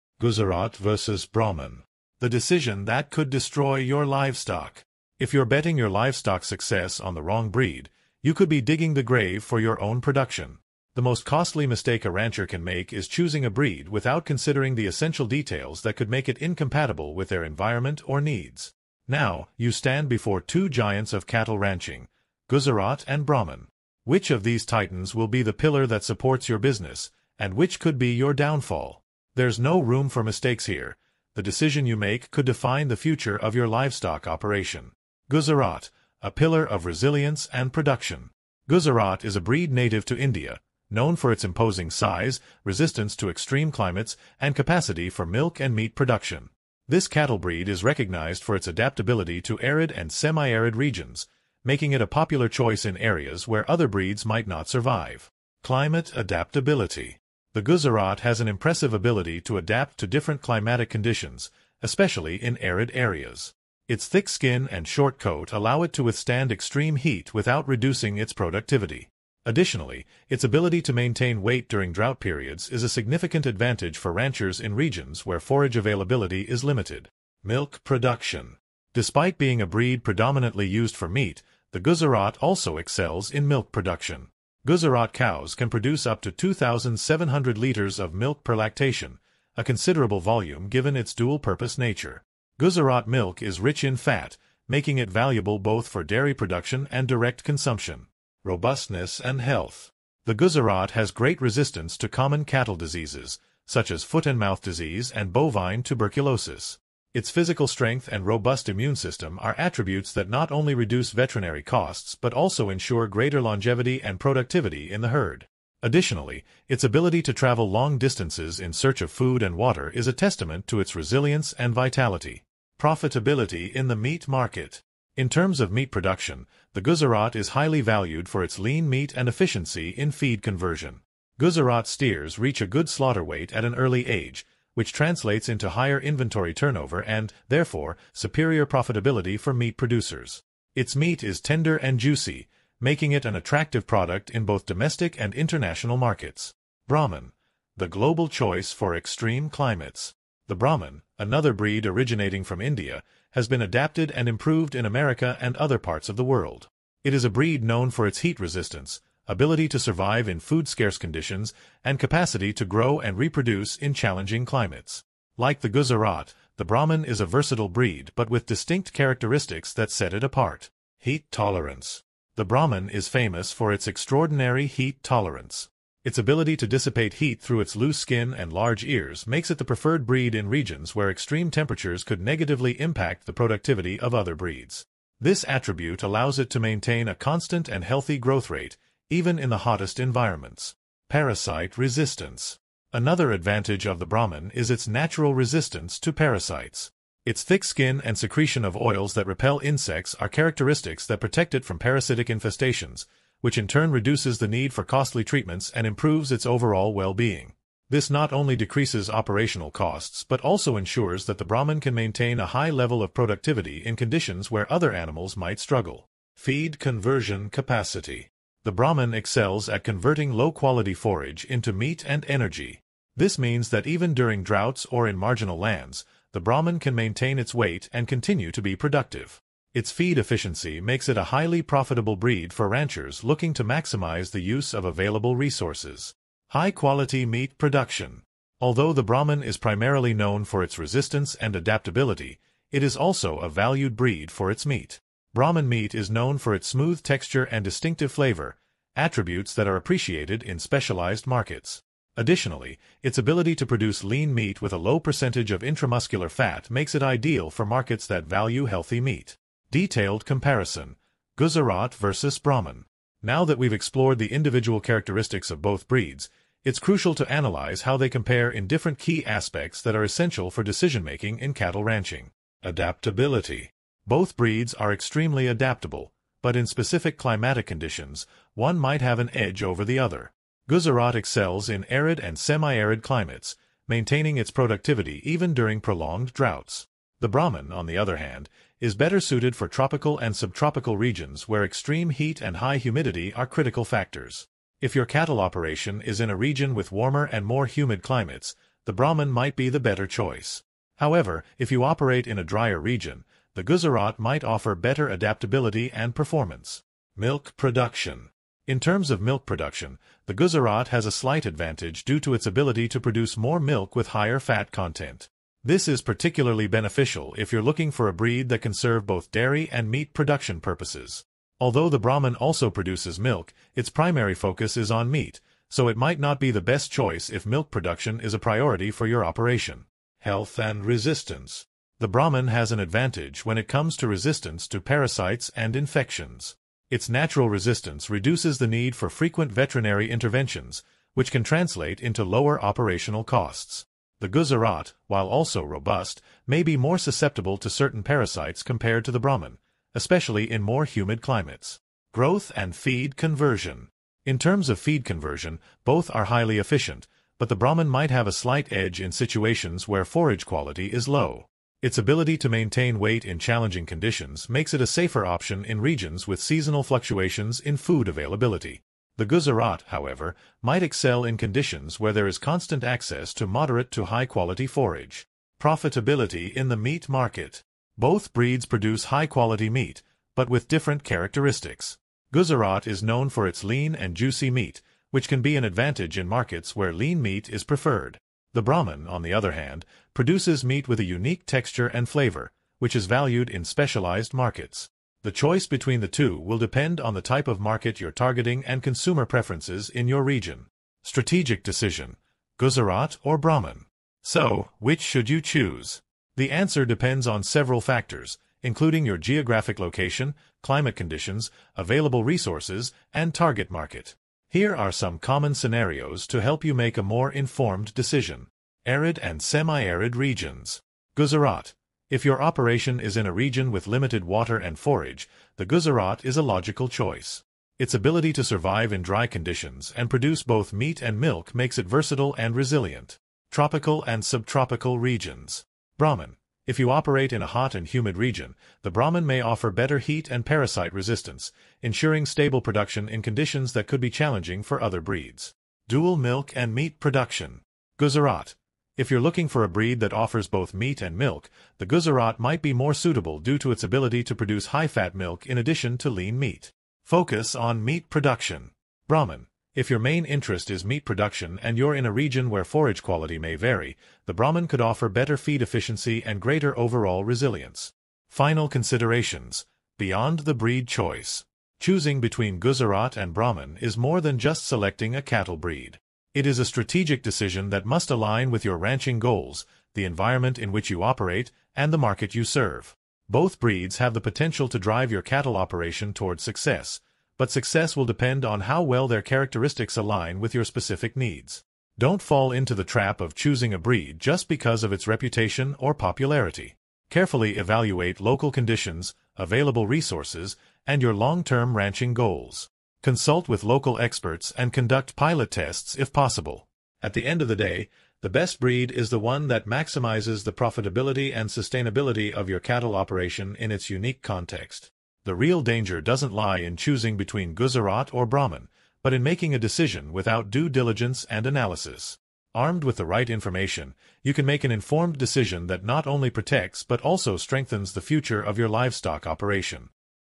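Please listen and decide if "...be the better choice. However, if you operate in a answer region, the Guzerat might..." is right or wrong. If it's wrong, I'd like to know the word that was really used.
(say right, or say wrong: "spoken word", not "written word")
wrong: "drier", not "answer".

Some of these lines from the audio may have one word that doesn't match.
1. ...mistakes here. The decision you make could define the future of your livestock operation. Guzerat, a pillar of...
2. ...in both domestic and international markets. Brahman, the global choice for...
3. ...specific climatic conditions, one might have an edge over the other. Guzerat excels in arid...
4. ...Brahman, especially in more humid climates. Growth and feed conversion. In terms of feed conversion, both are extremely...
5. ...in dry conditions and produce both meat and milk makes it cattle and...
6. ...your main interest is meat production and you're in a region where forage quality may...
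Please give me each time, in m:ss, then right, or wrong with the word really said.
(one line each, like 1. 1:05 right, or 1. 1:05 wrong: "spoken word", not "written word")
1. 0:30 right
2. 2:24 right
3. 4:36 right
4. 5:49 wrong: "highly", not "extremely"
5. 7:08 wrong: "versatile", not "cattle"
6. 7:39 right.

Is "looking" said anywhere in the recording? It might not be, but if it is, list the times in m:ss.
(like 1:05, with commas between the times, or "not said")
3:53, 5:17, 7:29.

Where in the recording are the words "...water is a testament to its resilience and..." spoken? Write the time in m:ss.
1:59.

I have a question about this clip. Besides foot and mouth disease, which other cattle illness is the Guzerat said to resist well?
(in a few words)
Bovine tuberculosis.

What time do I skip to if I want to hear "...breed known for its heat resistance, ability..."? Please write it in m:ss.
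2:37.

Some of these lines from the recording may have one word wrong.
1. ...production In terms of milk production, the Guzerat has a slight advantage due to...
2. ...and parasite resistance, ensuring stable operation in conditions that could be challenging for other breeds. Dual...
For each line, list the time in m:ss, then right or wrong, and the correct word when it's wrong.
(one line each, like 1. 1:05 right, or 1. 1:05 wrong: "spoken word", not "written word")
1. 5:07 right
2. 7:20 wrong: "production", not "operation".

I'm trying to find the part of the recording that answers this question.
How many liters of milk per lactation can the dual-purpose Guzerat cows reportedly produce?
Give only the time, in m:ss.
1:26.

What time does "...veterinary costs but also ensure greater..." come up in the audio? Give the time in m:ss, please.
1:51.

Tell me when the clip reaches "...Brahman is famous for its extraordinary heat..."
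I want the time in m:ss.
2:52.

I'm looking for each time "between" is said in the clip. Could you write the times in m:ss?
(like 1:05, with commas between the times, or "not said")
6:35, 7:52, 8:37.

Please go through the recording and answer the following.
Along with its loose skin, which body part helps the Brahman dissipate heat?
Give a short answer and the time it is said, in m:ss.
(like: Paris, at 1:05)
Large ears, at 2:58.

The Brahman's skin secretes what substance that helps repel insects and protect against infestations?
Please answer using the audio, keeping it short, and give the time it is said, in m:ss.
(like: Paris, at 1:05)
Oils, at 3:18.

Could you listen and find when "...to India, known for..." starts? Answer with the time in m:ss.
0:40.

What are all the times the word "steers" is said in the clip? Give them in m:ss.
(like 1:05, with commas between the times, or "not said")
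2:11.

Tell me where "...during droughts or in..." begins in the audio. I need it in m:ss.
3:44.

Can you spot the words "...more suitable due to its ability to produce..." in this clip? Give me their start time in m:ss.
7:32.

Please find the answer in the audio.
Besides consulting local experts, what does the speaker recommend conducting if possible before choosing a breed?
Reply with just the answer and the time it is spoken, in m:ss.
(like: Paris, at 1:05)
Pilot tests, at 8:25.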